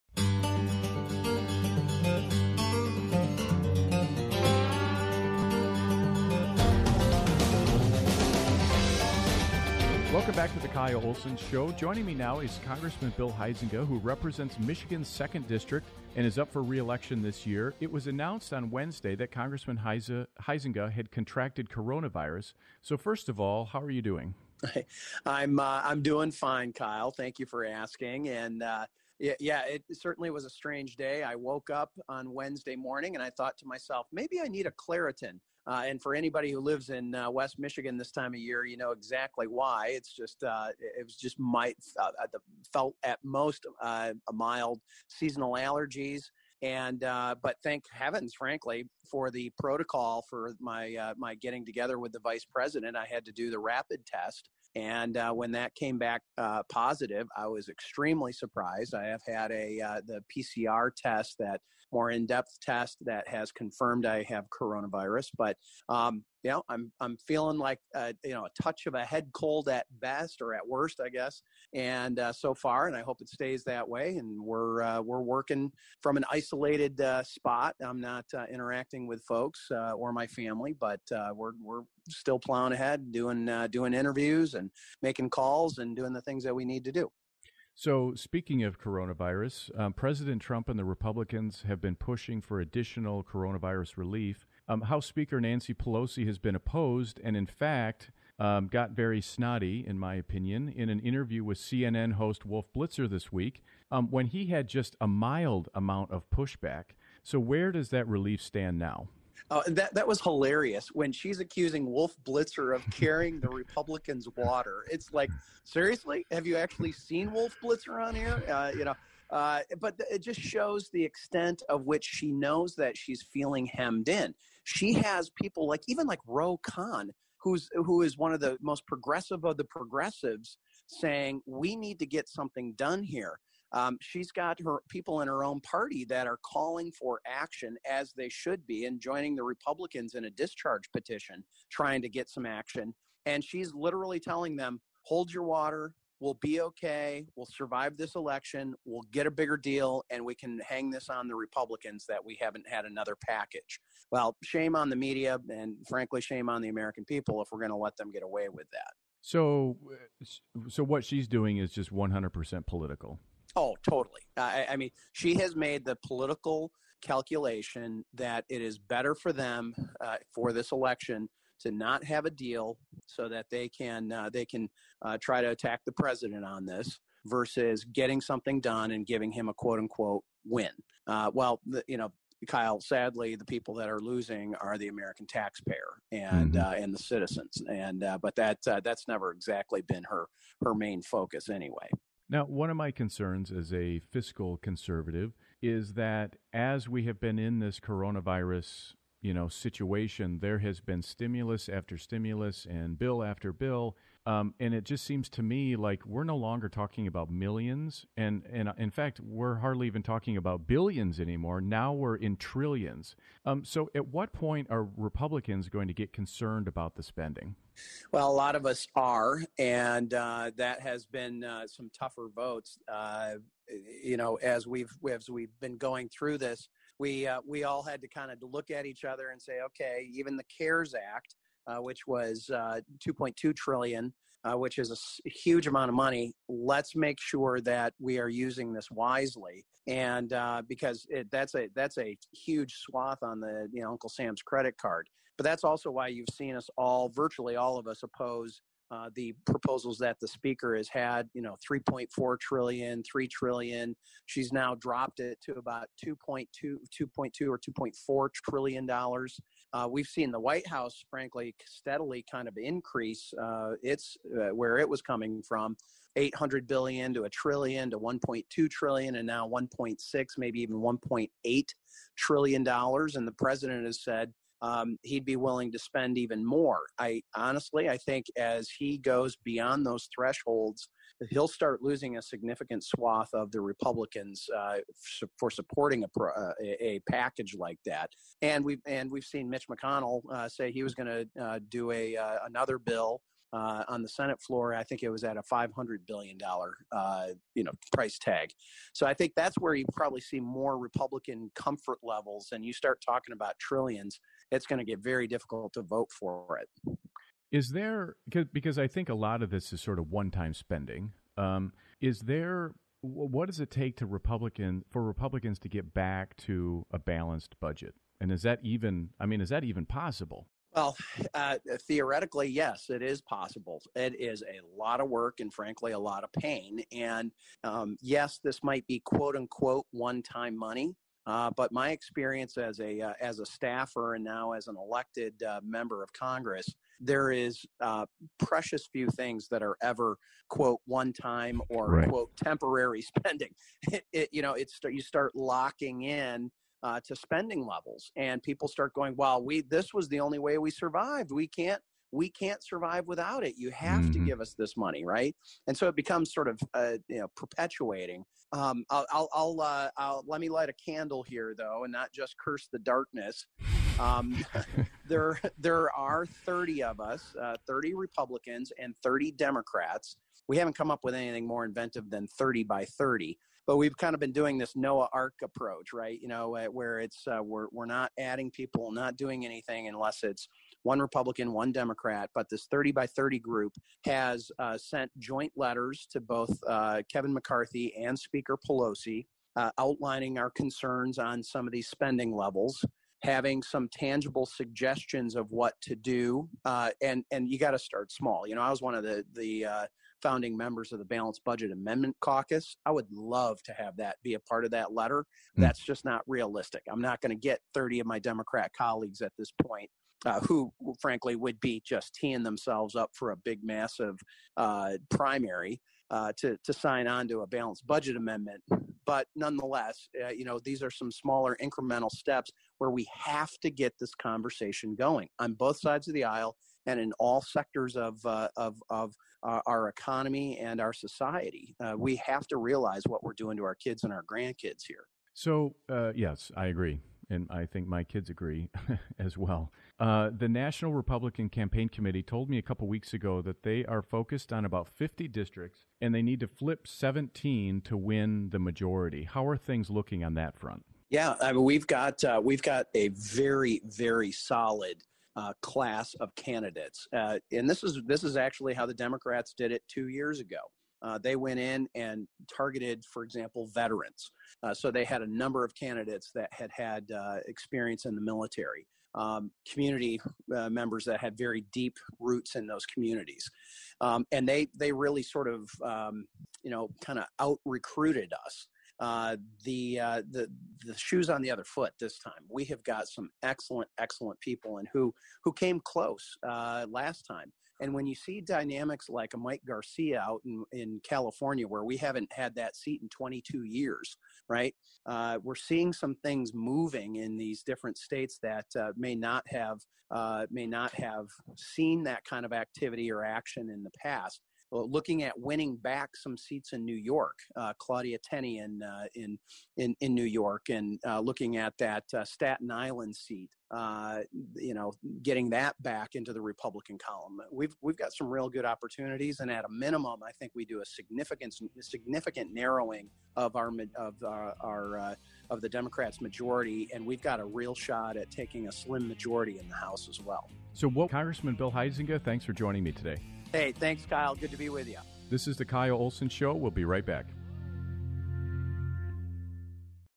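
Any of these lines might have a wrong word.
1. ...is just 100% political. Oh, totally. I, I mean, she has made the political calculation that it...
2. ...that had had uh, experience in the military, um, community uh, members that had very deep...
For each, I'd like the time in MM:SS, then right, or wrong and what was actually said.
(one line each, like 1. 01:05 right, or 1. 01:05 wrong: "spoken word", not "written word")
1. 02:41 right
2. 07:46 right.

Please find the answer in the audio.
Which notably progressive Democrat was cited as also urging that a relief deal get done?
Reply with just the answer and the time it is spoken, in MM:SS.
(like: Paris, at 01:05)
Ro Khanna, at 02:06.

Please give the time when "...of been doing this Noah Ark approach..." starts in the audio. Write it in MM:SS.
06:14.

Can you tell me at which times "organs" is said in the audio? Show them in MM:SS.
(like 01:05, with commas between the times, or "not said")
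not said.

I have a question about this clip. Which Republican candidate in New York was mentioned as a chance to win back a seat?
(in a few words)
Claudia Tenney.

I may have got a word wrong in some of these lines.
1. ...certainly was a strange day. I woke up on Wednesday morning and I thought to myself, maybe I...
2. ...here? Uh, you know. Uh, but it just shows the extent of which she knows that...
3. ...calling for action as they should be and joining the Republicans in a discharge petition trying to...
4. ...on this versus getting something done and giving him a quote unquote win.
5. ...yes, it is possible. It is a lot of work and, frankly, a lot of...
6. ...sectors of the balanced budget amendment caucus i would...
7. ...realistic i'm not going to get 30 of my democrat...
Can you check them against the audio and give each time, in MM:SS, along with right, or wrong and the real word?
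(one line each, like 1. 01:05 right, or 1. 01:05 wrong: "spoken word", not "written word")
1. 00:29 right
2. 01:58 right
3. 02:16 right
4. 02:56 right
5. 05:22 right
6. 06:40 wrong: "members", not "sectors"
7. 06:46 right.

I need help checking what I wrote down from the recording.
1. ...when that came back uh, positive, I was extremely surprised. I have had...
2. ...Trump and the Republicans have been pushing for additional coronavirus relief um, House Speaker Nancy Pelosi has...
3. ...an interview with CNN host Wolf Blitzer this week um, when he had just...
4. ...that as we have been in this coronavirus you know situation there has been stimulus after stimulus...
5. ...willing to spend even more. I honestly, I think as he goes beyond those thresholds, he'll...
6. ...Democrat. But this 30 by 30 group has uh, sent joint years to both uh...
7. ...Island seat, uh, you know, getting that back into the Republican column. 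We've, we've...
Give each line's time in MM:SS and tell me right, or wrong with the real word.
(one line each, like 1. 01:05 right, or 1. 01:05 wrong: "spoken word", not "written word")
1. 00:55 right
2. 01:30 right
3. 01:40 right
4. 03:15 right
5. 04:35 right
6. 06:21 wrong: "letters", not "years"
7. 08:32 right.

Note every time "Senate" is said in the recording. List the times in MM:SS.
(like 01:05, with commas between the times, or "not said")
04:54.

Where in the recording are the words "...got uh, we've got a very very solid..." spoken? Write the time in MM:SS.
07:31.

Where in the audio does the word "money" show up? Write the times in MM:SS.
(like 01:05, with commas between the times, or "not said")
03:55, 05:30, 05:54.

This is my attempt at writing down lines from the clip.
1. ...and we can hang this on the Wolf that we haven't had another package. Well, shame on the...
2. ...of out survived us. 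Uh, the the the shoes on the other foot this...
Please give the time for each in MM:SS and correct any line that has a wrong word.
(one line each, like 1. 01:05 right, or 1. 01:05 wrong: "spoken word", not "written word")
1. 02:30 wrong: "Republicans", not "Wolf"
2. 07:57 wrong: "recruited", not "survived".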